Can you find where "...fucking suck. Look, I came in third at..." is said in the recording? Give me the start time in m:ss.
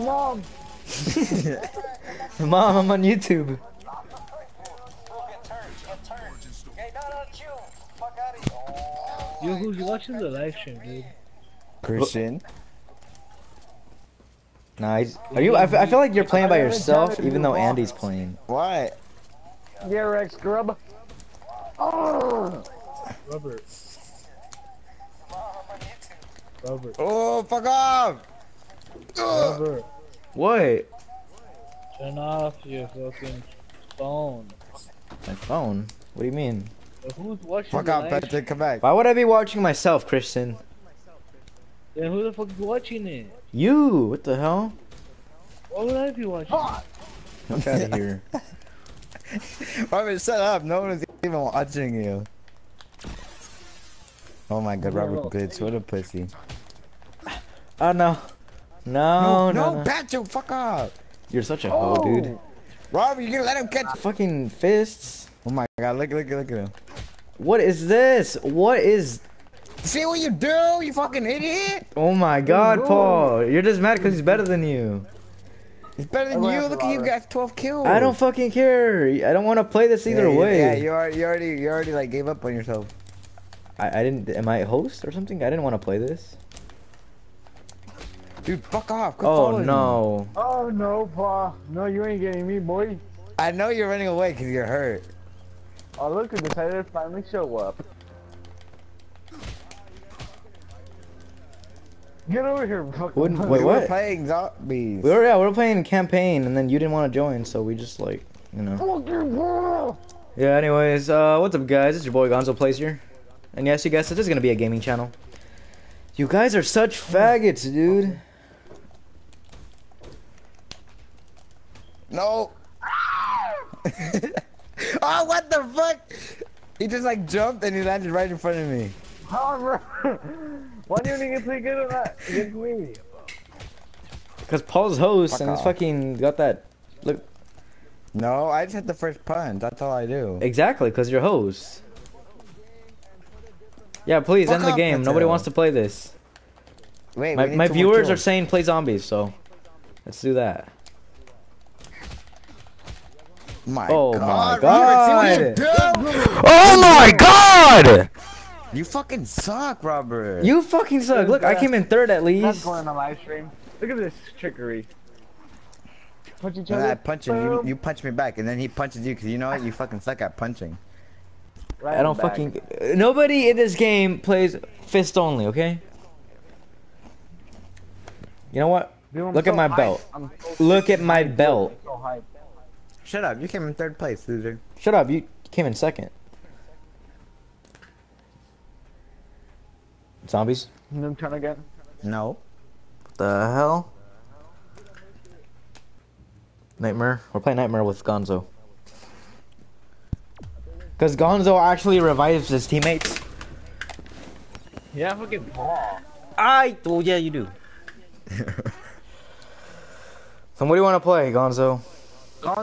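2:40.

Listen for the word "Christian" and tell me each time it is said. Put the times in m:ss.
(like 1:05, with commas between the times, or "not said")
0:11, 0:40.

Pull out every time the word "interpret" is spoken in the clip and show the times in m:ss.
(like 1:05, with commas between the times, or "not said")
not said.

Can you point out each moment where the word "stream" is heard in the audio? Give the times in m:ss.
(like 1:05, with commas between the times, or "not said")
0:10, 2:43.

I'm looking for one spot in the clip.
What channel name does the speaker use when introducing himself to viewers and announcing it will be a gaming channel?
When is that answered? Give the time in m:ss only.
1:52.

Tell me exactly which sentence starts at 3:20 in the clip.
Because Gonzo actually revives his teammates.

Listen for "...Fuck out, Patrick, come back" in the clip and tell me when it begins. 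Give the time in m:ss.
0:37.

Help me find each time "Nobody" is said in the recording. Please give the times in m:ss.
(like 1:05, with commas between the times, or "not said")
2:25, 2:52.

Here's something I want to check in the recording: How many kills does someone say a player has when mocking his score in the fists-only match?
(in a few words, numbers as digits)
12.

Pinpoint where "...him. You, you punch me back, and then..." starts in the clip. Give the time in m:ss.
2:47.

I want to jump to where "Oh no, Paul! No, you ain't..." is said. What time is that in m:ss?
1:30.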